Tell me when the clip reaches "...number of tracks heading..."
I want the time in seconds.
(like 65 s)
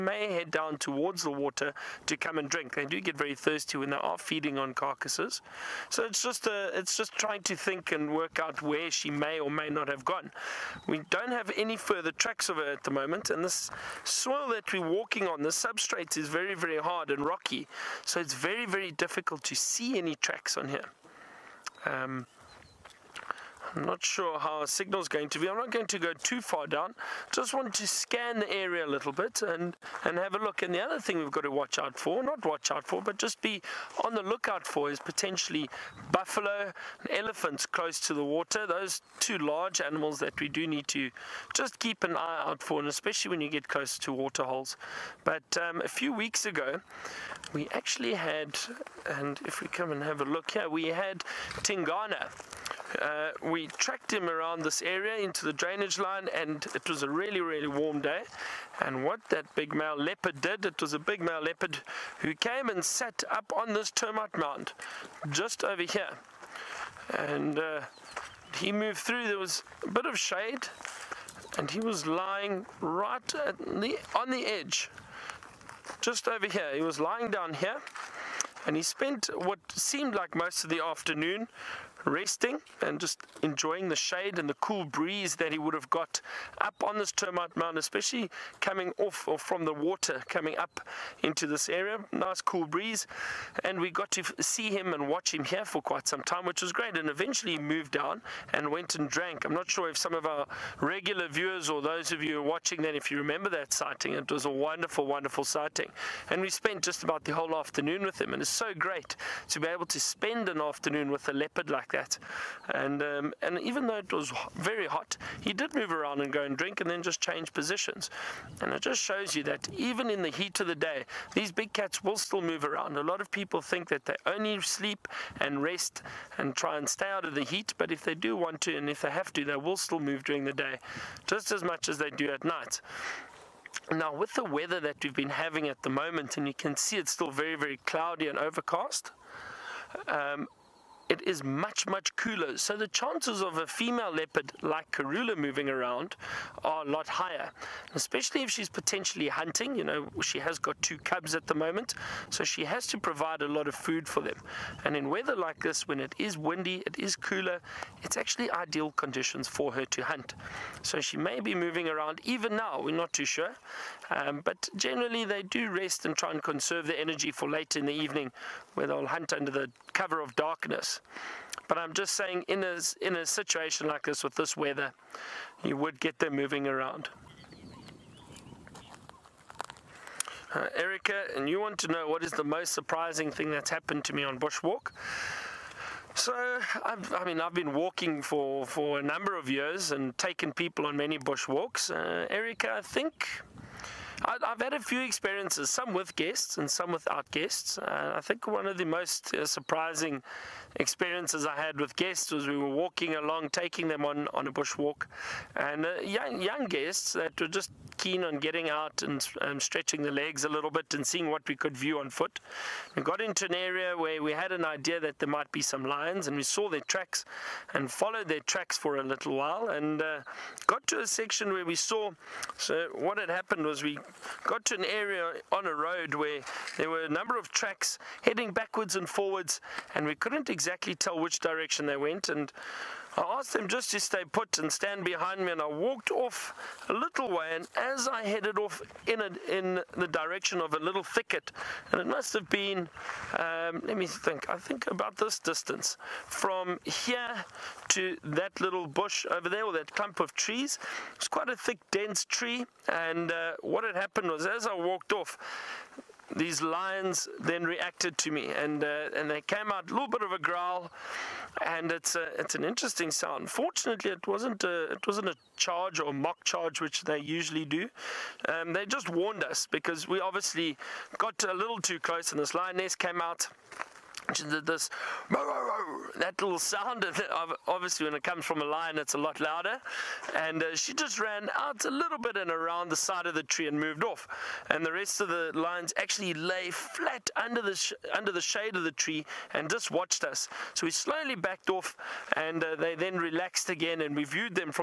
227 s.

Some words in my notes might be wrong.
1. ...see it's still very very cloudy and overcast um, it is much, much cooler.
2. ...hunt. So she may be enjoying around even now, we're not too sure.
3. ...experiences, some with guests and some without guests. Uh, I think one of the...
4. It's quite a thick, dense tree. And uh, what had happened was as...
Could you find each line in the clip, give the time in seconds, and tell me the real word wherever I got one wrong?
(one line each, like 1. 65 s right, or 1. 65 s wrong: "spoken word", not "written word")
1. 136 s right
2. 160 s wrong: "moving", not "enjoying"
3. 195 s right
4. 251 s right.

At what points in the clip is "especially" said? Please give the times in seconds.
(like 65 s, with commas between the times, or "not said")
42 s, 87 s, 147 s.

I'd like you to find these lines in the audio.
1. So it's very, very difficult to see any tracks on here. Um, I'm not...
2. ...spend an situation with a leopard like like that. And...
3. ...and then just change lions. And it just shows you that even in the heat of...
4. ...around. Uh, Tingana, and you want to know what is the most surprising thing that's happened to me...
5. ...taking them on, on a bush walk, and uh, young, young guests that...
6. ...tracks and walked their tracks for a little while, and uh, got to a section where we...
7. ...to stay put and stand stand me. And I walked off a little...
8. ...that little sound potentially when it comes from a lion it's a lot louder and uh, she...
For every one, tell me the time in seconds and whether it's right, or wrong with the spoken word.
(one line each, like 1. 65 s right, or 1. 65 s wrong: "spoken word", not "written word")
1. 18 s right
2. 109 s wrong: "afternoon", not "situation"
3. 116 s wrong: "positions", not "lions"
4. 176 s wrong: "Erica", not "Tingana"
5. 203 s right
6. 216 s wrong: "followed", not "walked"
7. 233 s wrong: "behind", not "stand"
8. 276 s wrong: "obviously", not "potentially".